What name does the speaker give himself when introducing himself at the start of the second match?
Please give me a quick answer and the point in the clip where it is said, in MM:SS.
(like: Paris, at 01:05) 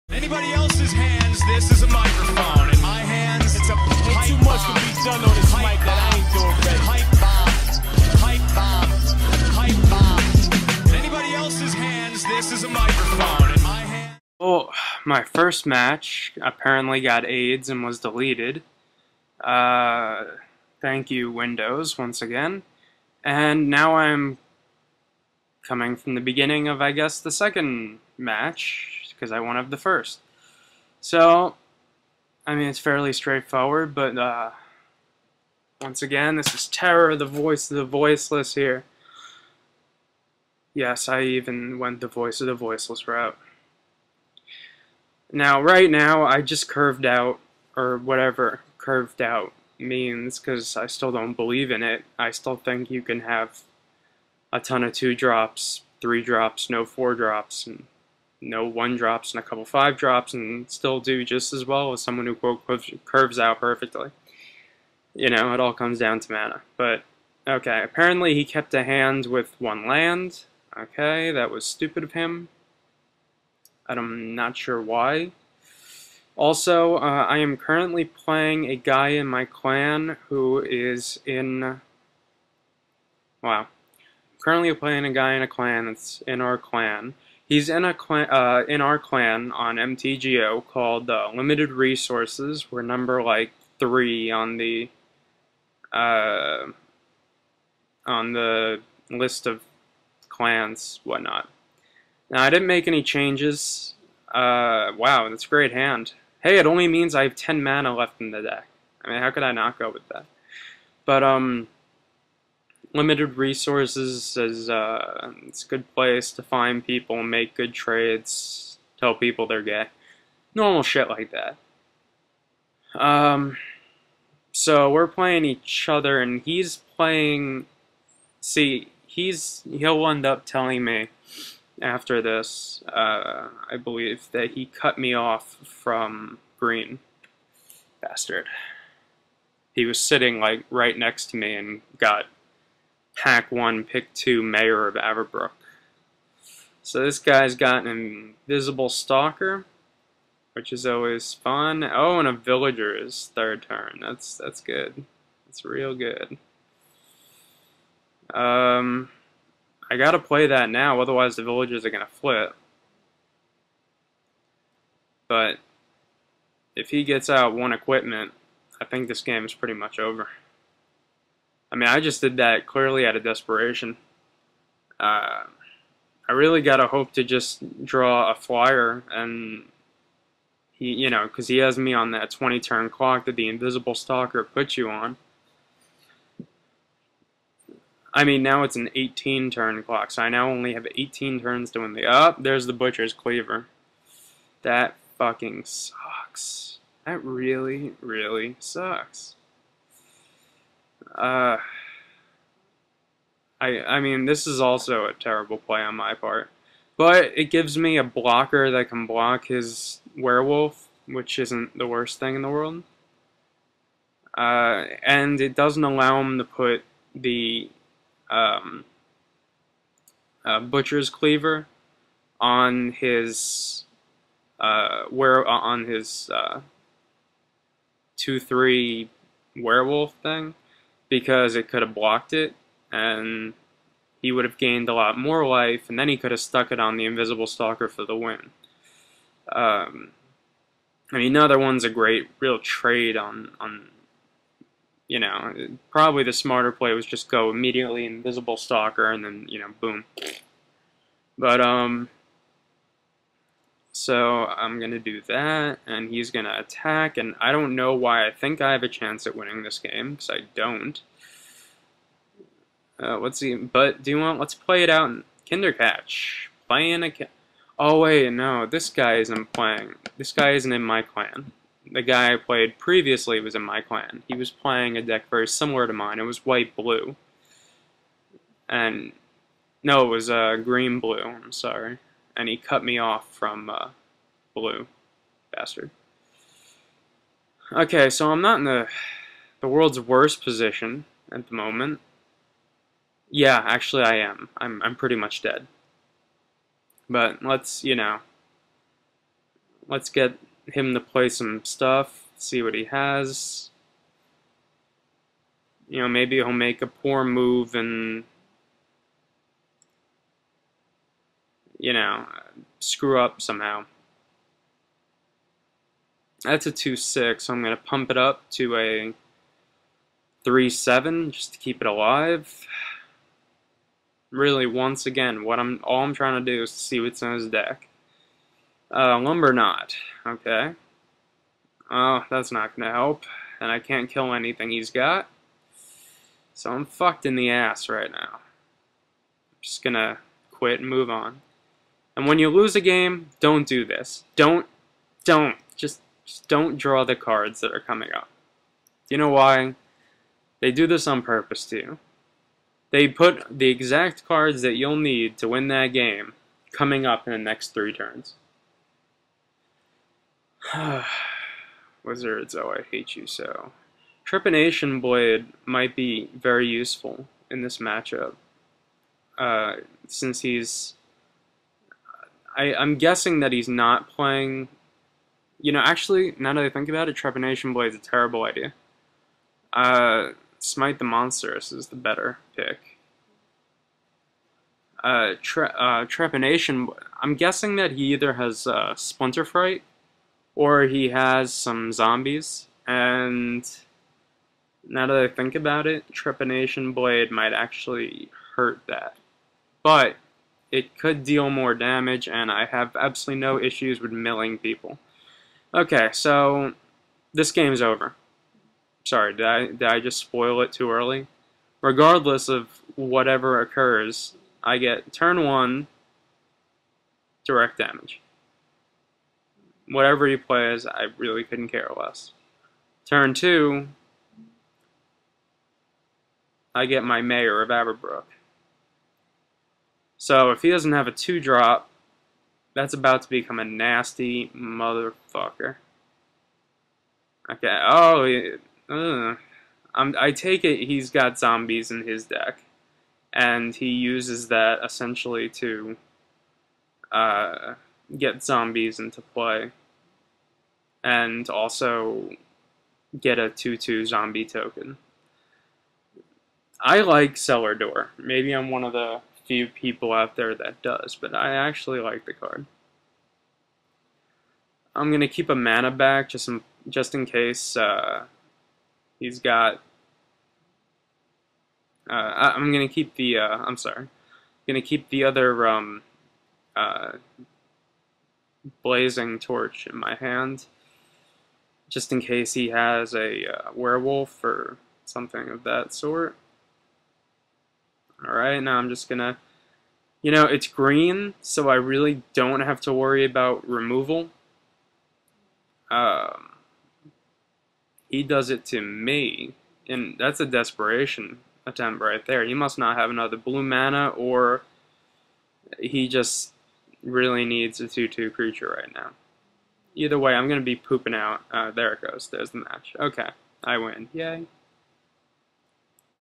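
Terror, at 00:36.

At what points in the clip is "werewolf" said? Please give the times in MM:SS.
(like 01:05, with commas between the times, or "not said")
03:30, 03:49, 08:03.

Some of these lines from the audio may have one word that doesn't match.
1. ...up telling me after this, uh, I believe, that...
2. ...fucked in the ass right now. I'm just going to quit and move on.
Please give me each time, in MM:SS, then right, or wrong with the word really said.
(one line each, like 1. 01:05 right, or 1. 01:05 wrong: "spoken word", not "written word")
1. 02:10 right
2. 05:36 right.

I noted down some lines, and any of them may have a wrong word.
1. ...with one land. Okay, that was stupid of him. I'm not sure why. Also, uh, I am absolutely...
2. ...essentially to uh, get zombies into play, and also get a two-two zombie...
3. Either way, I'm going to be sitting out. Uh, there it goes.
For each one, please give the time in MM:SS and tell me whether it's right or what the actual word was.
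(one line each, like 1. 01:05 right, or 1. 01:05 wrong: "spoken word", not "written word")
1. 01:09 wrong: "currently", not "absolutely"
2. 07:24 right
3. 08:29 wrong: "pooping", not "sitting".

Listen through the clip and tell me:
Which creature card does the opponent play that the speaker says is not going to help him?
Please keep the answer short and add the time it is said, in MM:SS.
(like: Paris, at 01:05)
Lumberknot, at 05:29.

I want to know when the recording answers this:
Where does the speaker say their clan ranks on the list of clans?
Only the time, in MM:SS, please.
01:32.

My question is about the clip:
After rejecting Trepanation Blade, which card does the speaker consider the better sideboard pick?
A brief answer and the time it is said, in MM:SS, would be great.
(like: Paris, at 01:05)
Smite the Monstrous, at 06:20.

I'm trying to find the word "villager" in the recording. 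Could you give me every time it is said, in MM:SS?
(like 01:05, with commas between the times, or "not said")
02:32, 02:41.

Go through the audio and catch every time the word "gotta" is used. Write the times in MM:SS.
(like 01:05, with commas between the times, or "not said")
02:39, 02:56.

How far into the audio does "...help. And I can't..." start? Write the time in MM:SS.
05:32.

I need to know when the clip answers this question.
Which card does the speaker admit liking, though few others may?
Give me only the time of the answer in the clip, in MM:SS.
07:37.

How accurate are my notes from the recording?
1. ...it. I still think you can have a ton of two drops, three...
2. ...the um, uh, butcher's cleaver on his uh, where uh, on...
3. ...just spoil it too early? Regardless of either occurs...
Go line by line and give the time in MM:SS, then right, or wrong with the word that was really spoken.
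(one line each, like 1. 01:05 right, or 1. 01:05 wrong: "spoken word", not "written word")
1. 00:51 right
2. 03:37 right
3. 06:49 wrong: "whatever", not "either".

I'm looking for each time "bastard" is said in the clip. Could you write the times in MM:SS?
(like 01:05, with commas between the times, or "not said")
02:18, 04:45.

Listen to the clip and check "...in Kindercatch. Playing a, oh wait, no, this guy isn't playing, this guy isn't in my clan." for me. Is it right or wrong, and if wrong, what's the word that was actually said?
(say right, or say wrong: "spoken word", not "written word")
right.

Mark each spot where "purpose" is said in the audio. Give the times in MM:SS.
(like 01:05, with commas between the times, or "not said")
05:51.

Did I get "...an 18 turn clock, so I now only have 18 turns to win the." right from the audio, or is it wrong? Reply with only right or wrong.
right.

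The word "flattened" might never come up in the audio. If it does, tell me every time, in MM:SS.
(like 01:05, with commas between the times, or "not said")
not said.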